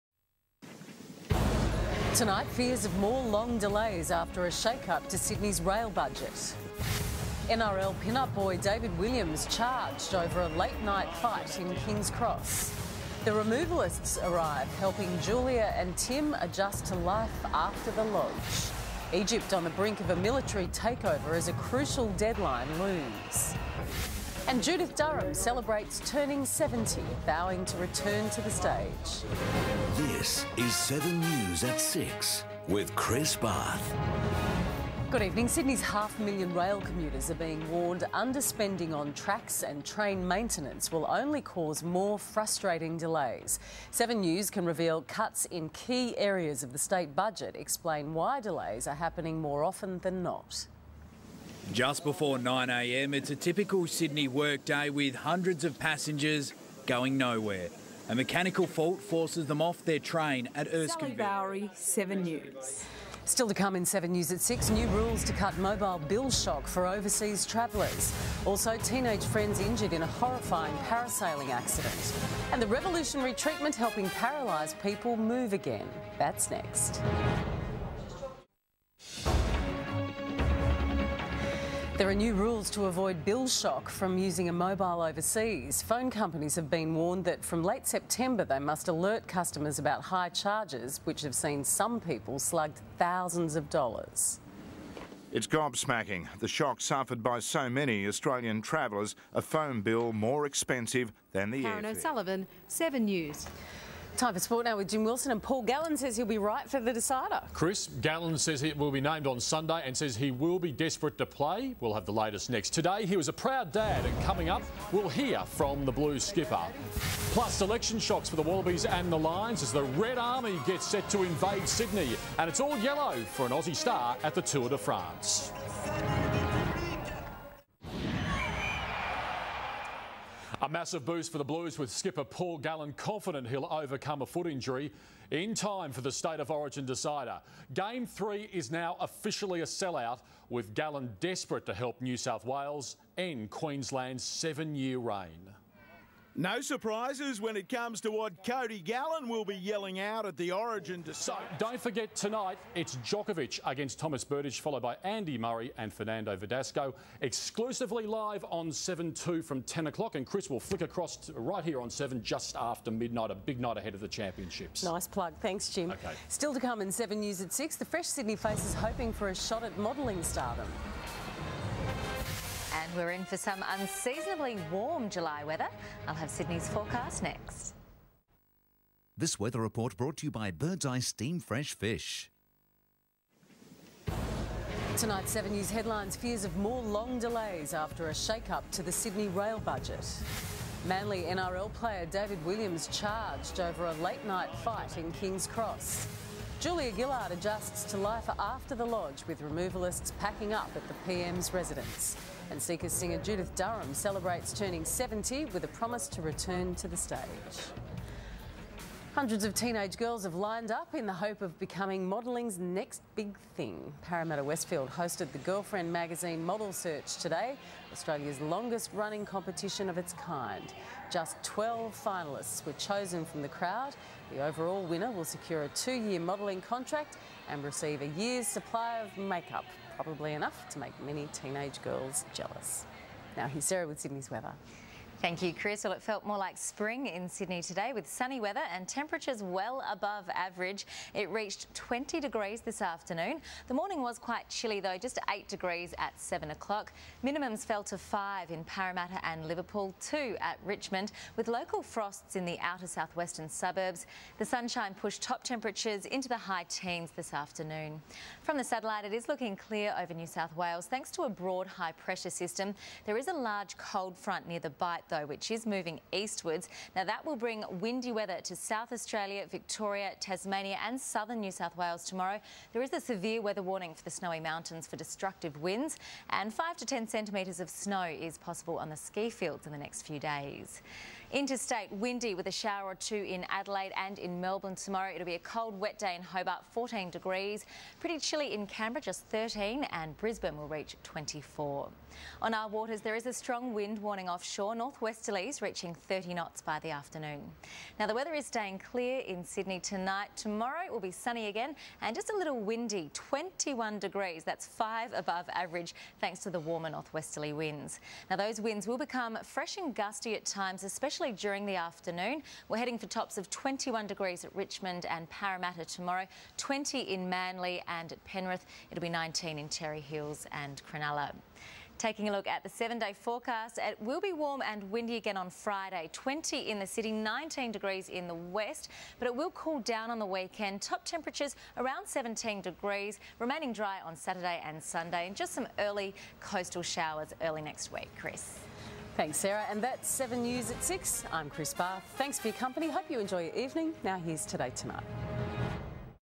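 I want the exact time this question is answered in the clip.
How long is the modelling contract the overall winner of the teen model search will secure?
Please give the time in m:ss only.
3:45.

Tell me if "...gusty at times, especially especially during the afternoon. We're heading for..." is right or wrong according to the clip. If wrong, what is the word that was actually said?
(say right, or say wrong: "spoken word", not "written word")
right.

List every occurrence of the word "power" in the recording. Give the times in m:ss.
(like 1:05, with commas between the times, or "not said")
not said.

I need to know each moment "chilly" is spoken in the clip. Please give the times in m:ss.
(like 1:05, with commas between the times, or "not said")
4:04, 4:48.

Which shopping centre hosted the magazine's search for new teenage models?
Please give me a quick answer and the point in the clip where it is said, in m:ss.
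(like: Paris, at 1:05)
Parramatta Westfield, at 3:34.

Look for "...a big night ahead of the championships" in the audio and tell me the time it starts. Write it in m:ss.
2:43.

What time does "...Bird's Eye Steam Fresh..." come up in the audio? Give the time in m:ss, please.
3:00.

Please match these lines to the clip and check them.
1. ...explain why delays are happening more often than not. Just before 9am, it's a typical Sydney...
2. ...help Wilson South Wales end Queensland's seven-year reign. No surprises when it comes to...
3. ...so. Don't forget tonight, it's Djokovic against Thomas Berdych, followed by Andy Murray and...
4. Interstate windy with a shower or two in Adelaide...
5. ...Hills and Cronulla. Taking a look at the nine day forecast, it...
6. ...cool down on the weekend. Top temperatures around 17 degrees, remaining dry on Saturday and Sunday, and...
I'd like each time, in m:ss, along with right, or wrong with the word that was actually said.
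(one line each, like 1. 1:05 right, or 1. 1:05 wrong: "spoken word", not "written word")
1. 0:47 right
2. 2:21 wrong: "New", not "Wilson"
3. 2:31 right
4. 4:41 right
5. 5:20 wrong: "seven", not "nine"
6. 5:29 right.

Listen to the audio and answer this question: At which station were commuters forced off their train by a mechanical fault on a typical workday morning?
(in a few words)
Erskine.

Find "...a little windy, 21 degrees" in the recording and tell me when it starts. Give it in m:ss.
5:02.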